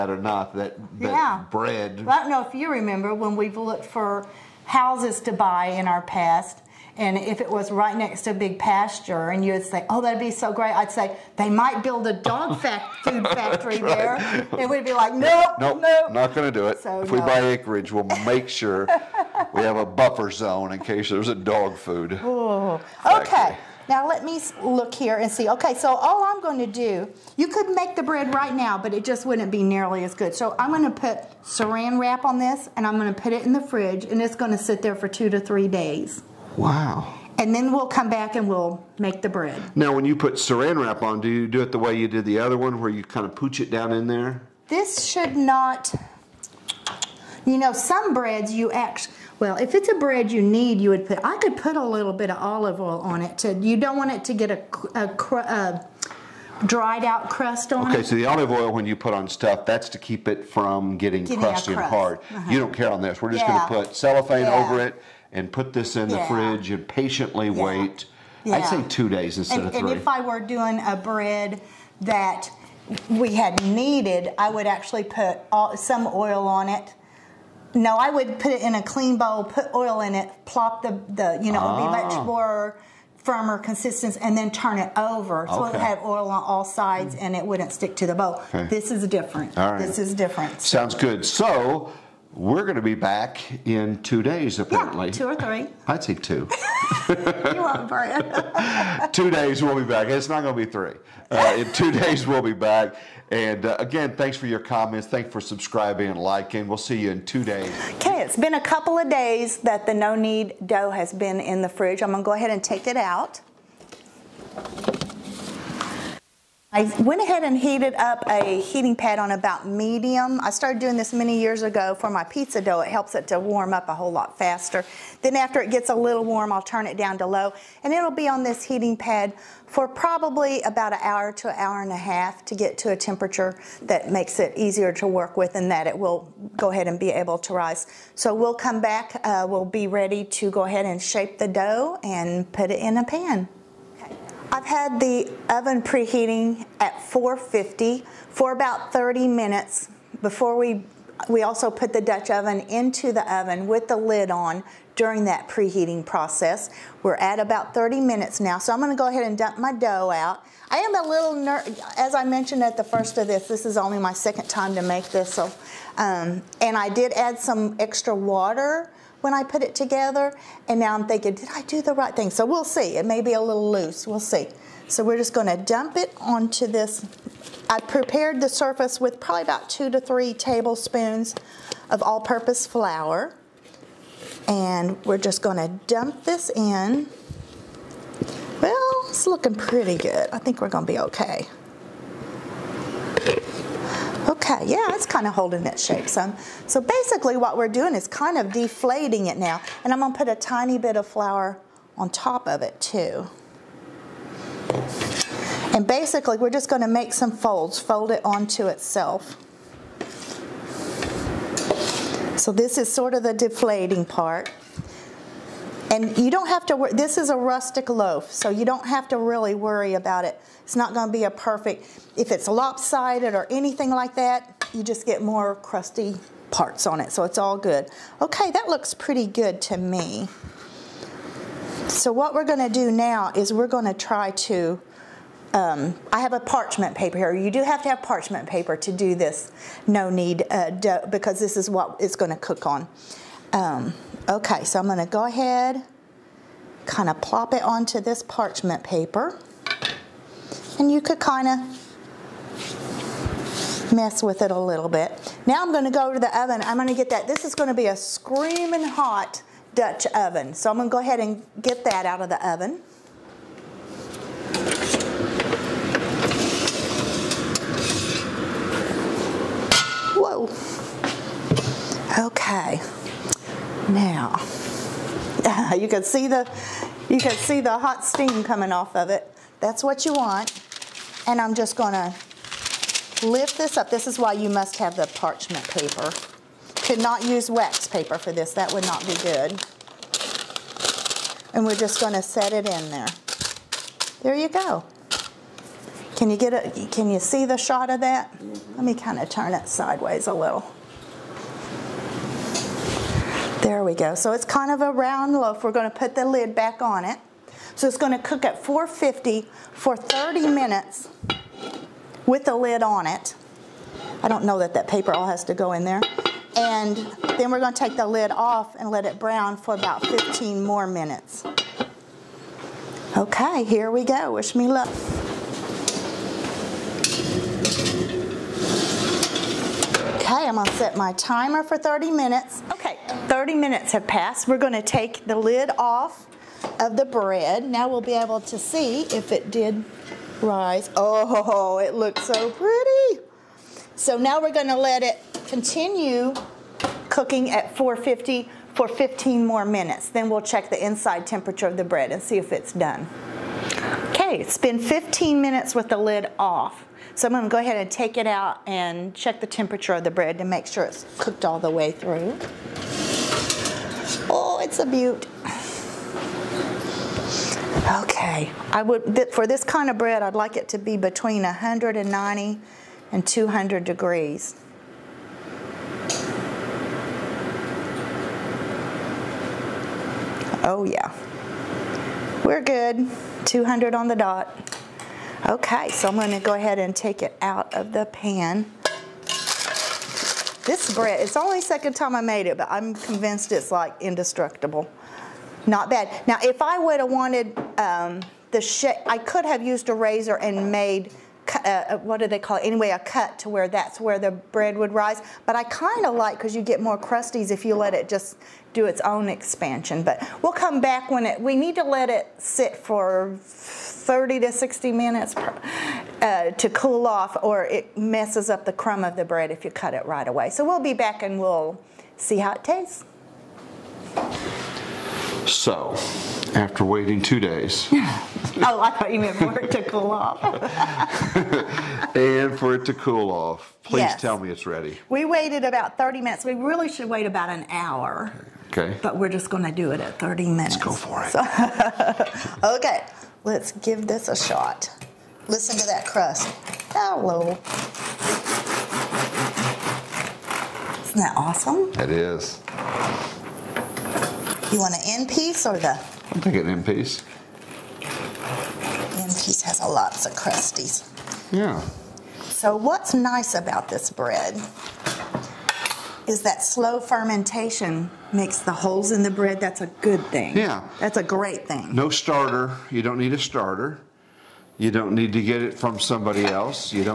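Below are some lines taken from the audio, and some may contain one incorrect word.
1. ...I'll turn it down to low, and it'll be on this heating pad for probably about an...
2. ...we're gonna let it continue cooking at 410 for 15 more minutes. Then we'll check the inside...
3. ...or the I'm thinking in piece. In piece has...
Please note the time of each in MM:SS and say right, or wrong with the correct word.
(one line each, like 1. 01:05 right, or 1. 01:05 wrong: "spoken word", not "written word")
1. 02:06 right
2. 05:44 wrong: "450", not "410"
3. 07:35 right.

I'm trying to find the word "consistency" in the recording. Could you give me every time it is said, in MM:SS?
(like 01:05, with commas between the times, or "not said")
01:23.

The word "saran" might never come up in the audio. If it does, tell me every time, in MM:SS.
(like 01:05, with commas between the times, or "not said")
00:31, 00:40.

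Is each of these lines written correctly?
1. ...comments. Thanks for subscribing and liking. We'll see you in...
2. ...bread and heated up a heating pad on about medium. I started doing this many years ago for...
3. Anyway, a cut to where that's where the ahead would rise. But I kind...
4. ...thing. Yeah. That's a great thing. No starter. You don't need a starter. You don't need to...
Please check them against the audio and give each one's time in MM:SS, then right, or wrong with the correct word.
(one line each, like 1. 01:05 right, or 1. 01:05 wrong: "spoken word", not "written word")
1. 01:44 right
2. 01:57 wrong: "ahead", not "bread"
3. 06:42 wrong: "bread", not "ahead"
4. 07:50 right.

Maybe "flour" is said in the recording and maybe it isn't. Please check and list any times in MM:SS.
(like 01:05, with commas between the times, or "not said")
03:02, 03:21.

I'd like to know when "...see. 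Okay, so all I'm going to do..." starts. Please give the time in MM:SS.
00:25.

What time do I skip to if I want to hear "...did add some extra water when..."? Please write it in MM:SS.
02:46.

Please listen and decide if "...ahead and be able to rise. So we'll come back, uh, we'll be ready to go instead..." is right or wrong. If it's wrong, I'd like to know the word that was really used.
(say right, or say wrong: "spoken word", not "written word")
wrong: "ahead", not "instead".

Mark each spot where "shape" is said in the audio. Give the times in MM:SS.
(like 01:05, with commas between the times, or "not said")
02:21, 03:15, 06:38.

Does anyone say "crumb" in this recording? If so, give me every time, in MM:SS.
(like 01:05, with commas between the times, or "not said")
06:58.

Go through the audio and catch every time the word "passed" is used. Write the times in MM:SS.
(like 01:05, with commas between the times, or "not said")
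05:34.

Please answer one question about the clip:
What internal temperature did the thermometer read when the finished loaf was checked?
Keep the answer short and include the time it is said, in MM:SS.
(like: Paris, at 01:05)
200, at 06:23.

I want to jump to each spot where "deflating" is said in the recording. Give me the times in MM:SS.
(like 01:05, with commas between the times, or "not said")
03:18, 03:33.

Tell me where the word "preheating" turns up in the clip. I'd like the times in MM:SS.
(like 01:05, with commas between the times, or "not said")
02:25, 02:35.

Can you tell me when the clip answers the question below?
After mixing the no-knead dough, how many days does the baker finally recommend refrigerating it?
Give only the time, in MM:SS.
01:08.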